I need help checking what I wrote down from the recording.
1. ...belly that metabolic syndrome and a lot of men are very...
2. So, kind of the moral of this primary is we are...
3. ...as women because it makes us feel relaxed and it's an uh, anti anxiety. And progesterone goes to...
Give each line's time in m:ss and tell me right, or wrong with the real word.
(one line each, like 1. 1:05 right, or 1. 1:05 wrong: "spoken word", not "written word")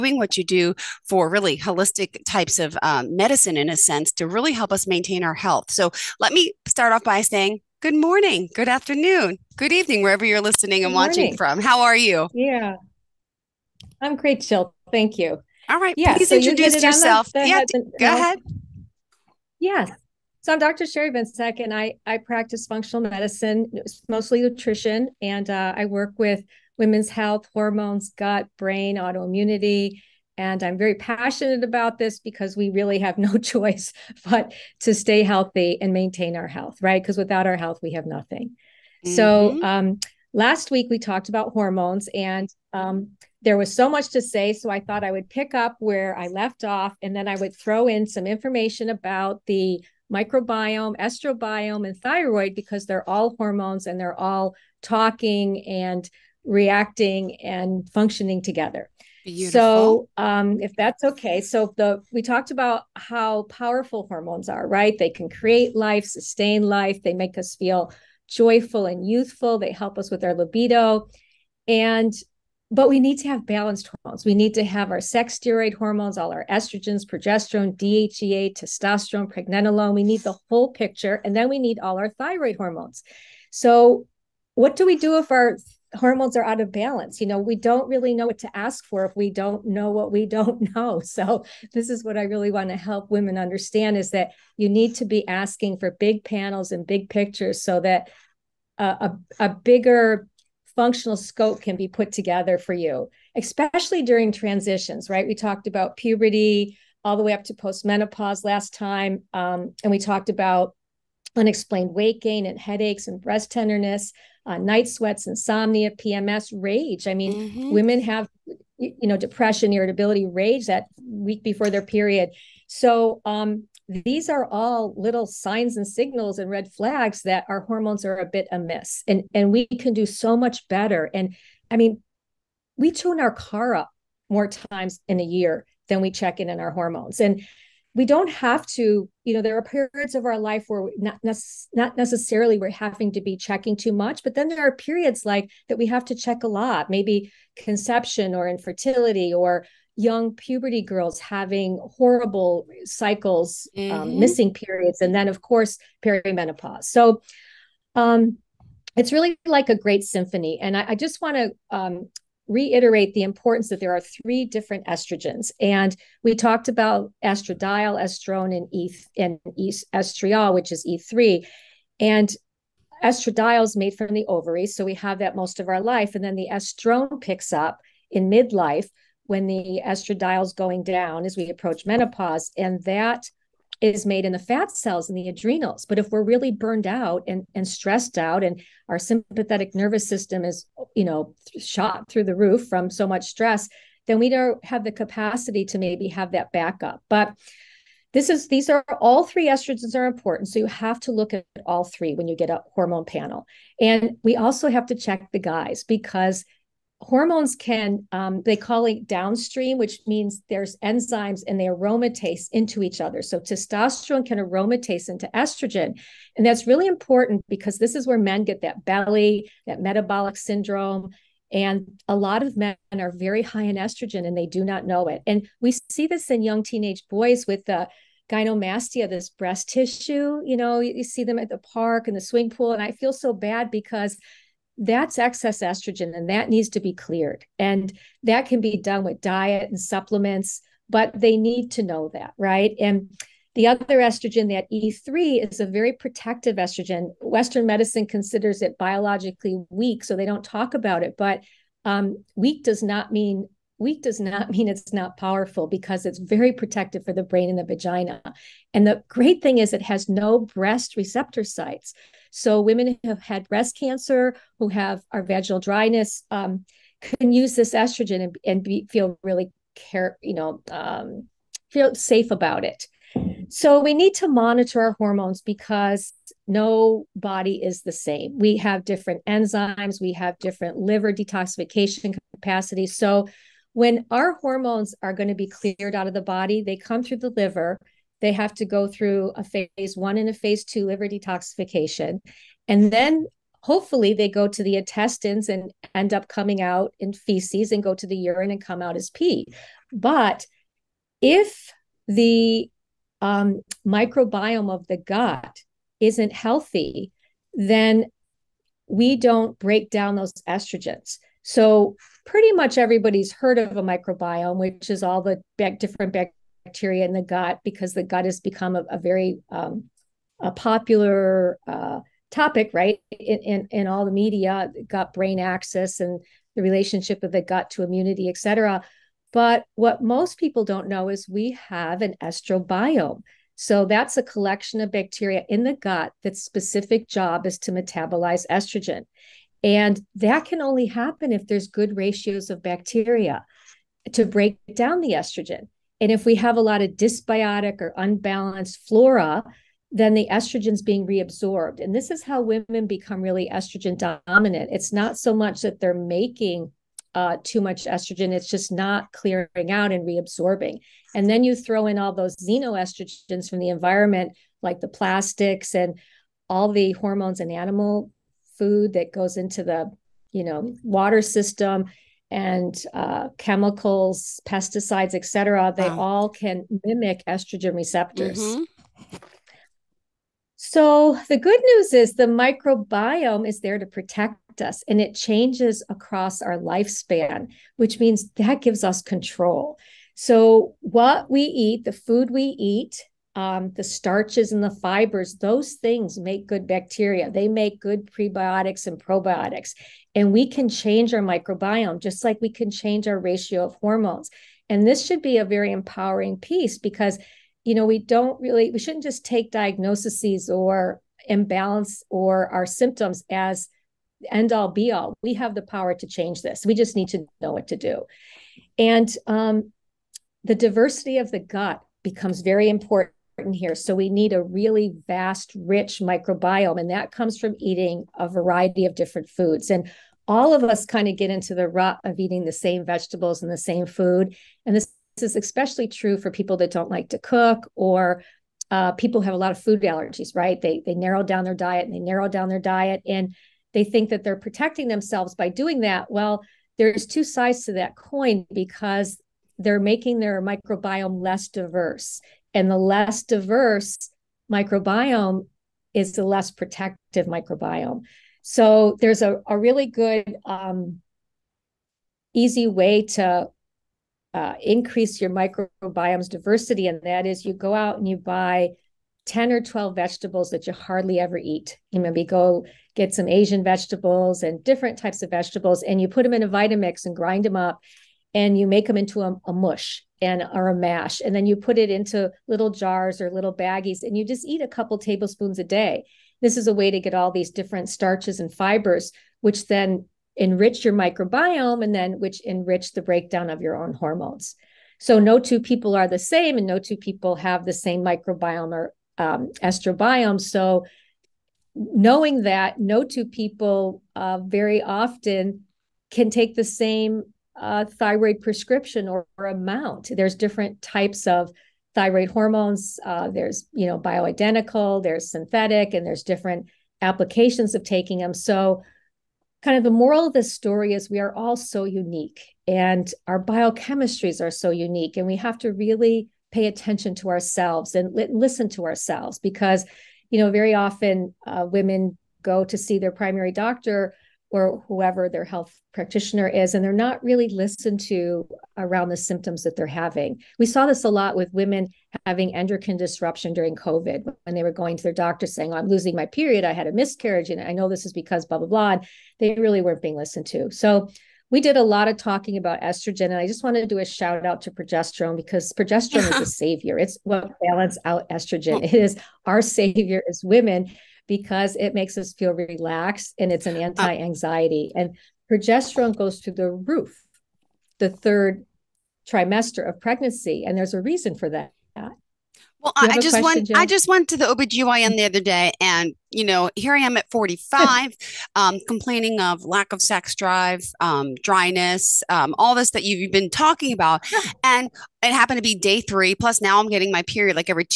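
1. 3:38 right
2. 8:38 wrong: "story", not "primary"
3. 9:20 right.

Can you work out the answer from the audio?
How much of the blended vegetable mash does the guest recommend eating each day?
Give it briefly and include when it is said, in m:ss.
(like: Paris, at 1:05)
A couple tablespoons, at 8:04.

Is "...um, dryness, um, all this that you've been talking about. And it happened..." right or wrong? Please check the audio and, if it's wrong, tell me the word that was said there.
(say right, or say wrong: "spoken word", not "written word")
right.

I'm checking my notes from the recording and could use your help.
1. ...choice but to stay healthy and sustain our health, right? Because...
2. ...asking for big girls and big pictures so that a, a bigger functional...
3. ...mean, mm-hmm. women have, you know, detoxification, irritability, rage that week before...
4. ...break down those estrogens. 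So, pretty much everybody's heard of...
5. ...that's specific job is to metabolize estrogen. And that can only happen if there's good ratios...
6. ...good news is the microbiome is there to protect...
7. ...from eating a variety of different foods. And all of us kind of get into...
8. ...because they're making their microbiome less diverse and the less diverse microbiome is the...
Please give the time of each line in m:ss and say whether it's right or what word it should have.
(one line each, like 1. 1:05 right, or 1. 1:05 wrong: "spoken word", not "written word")
1. 0:33 wrong: "maintain", not "sustain"
2. 1:35 wrong: "panels", not "girls"
3. 1:57 wrong: "depression", not "detoxification"
4. 5:09 right
5. 5:36 right
6. 6:21 right
7. 7:07 right
8. 7:28 right.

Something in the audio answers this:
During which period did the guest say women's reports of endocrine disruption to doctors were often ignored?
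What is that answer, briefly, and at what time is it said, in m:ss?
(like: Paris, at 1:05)
COVID, at 9:03.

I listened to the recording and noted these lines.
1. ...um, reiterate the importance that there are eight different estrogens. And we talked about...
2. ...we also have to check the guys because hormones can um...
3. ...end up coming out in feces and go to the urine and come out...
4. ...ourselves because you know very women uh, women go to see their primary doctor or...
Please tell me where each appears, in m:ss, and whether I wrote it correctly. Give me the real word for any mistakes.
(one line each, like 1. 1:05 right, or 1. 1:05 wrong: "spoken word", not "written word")
1. 2:41 wrong: "three", not "eight"
2. 3:24 right
3. 4:55 right
4. 8:48 wrong: "often", not "women".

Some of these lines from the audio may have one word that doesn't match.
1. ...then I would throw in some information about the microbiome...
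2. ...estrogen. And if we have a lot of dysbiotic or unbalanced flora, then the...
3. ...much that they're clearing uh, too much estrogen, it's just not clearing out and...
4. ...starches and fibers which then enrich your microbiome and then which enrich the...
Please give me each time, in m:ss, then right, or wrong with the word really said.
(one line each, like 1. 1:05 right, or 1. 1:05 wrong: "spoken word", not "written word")
1. 0:47 right
2. 5:45 right
3. 5:55 wrong: "making", not "clearing"
4. 8:07 right.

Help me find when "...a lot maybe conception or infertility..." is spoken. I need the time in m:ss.
2:26.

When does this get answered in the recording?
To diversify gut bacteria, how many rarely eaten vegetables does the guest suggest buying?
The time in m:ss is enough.
7:49.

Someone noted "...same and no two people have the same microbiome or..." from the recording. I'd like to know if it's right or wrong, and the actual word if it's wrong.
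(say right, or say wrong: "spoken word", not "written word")
right.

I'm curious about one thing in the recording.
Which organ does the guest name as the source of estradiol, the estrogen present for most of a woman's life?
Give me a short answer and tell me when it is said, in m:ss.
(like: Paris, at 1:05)
The ovary, at 2:54.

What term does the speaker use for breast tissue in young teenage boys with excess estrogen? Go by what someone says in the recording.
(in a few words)
Gynomastia.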